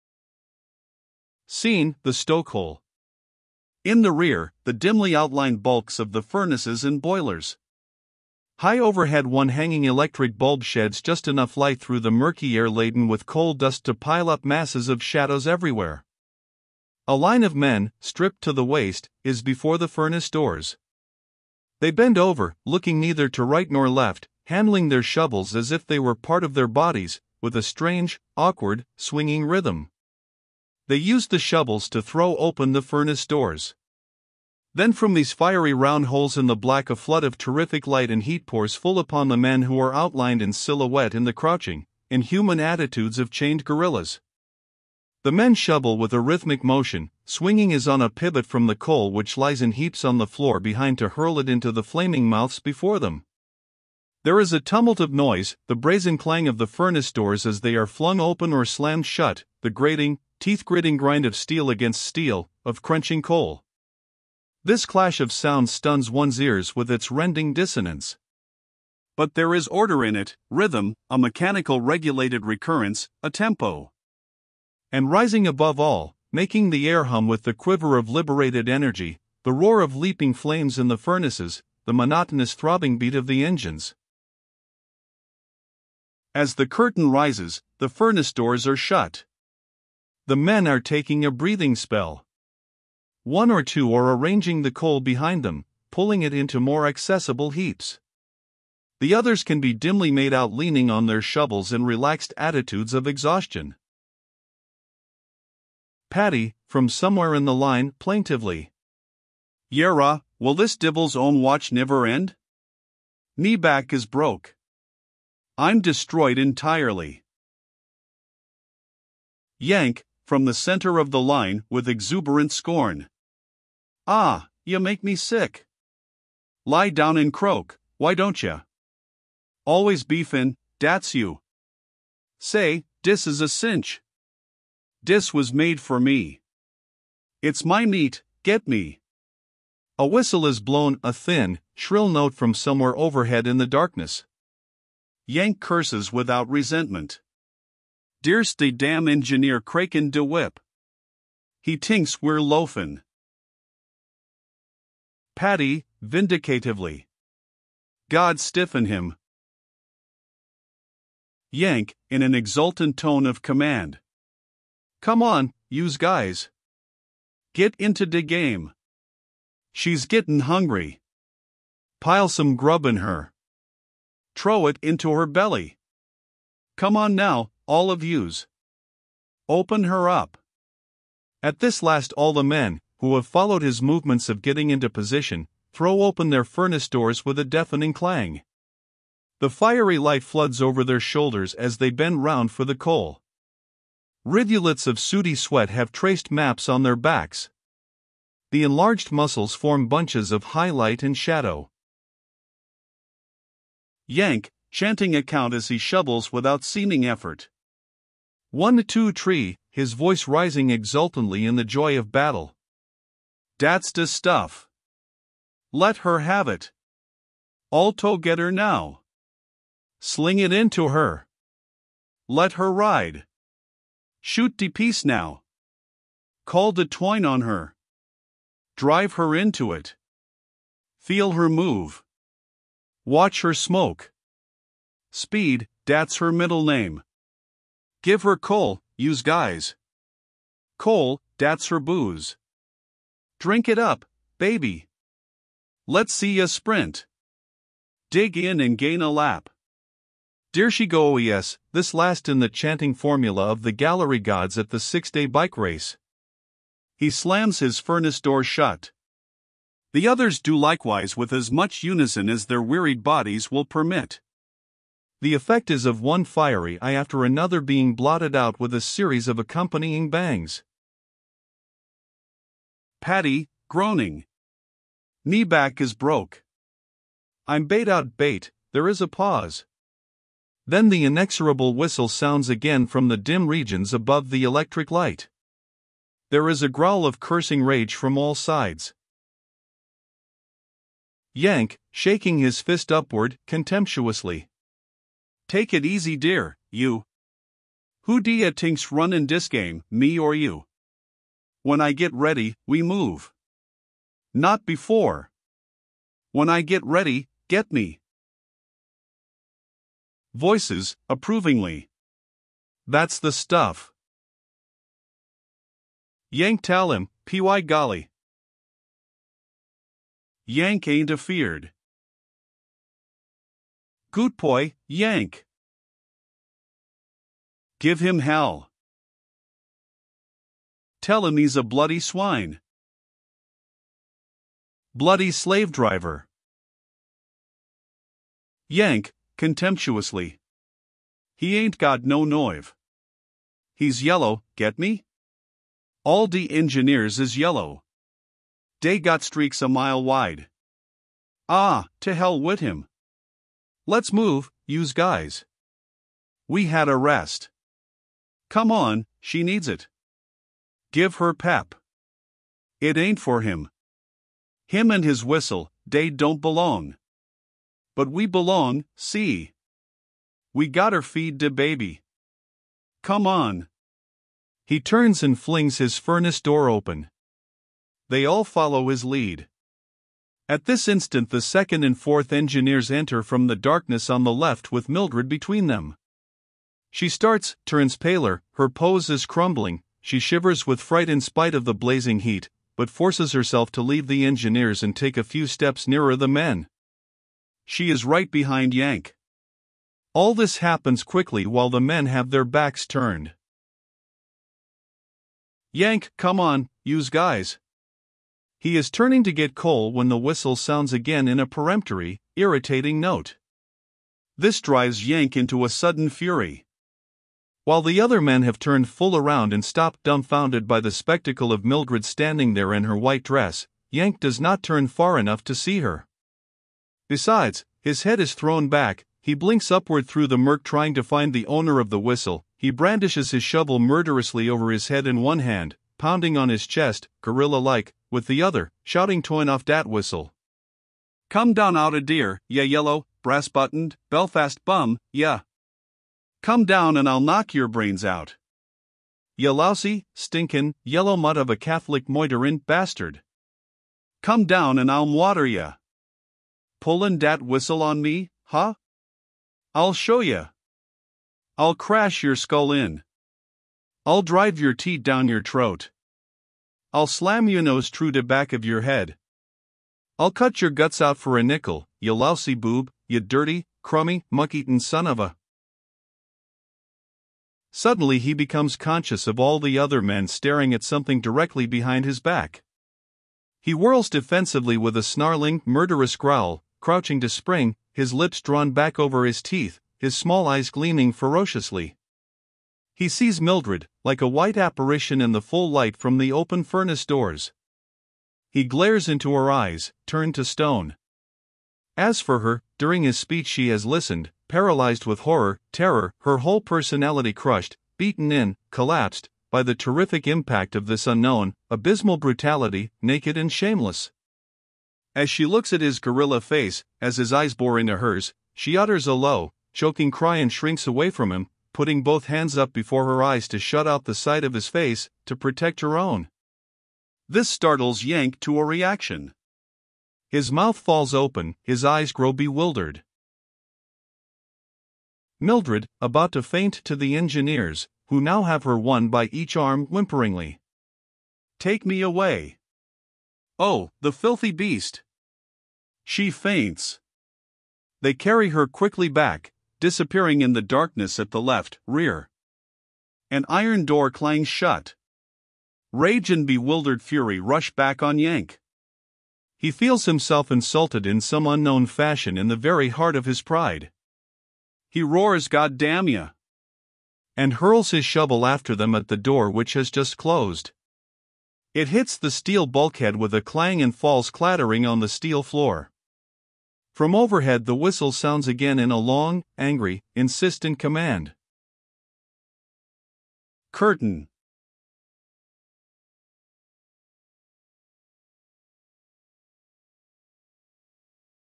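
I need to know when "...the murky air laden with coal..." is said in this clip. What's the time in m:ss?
0:11.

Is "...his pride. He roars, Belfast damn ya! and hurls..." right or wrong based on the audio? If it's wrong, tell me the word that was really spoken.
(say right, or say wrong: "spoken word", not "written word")
wrong: "God", not "Belfast".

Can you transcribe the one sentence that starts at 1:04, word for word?
This clash of sounds stuns one's ears with its rending dissonance.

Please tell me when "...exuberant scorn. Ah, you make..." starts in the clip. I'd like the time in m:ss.
2:01.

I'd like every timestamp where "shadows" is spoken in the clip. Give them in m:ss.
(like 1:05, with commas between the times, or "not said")
0:15, 3:21.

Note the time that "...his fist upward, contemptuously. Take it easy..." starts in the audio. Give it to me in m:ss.
4:52.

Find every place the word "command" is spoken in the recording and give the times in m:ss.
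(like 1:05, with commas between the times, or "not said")
2:43, 9:40.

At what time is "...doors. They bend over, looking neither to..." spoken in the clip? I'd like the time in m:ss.
0:20.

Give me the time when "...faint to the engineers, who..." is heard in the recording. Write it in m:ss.
8:56.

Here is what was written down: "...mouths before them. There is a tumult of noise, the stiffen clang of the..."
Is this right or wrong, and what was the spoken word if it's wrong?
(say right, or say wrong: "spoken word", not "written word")
wrong: "brazen", not "stiffen".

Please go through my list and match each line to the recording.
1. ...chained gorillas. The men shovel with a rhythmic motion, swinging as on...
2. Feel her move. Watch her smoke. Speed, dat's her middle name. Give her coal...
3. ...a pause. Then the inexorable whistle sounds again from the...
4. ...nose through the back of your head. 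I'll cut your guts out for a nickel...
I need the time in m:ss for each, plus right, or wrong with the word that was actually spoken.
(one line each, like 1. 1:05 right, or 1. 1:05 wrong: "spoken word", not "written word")
1. 0:43 right
2. 3:50 right
3. 4:38 right
4. 7:47 right.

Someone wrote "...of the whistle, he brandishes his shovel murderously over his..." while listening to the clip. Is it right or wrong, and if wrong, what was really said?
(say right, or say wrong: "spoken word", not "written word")
right.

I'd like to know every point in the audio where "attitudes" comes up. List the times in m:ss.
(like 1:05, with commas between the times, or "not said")
0:42, 1:42.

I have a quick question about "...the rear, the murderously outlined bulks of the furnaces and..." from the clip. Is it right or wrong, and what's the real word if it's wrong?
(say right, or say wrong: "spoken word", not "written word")
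wrong: "dimly", not "murderously".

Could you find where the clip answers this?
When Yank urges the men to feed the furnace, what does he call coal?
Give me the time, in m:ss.
4:01.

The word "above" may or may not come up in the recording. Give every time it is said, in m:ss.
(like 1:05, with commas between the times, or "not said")
1:15, 4:43.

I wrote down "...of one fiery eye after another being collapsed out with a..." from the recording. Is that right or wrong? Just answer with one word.
wrong.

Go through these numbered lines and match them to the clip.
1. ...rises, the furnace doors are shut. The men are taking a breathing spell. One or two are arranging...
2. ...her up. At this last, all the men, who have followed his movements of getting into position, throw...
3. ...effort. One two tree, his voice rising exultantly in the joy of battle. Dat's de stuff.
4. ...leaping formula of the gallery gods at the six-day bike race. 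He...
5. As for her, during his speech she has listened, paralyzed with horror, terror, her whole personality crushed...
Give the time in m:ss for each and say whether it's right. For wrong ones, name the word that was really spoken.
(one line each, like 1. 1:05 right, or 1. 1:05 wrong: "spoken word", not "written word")
1. 1:27 right
2. 2:59 right
3. 3:27 right
4. 4:12 wrong: "chanting", not "leaping"
5. 8:21 right.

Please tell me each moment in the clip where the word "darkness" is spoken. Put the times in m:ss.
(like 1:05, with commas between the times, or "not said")
2:23, 6:23, 9:10.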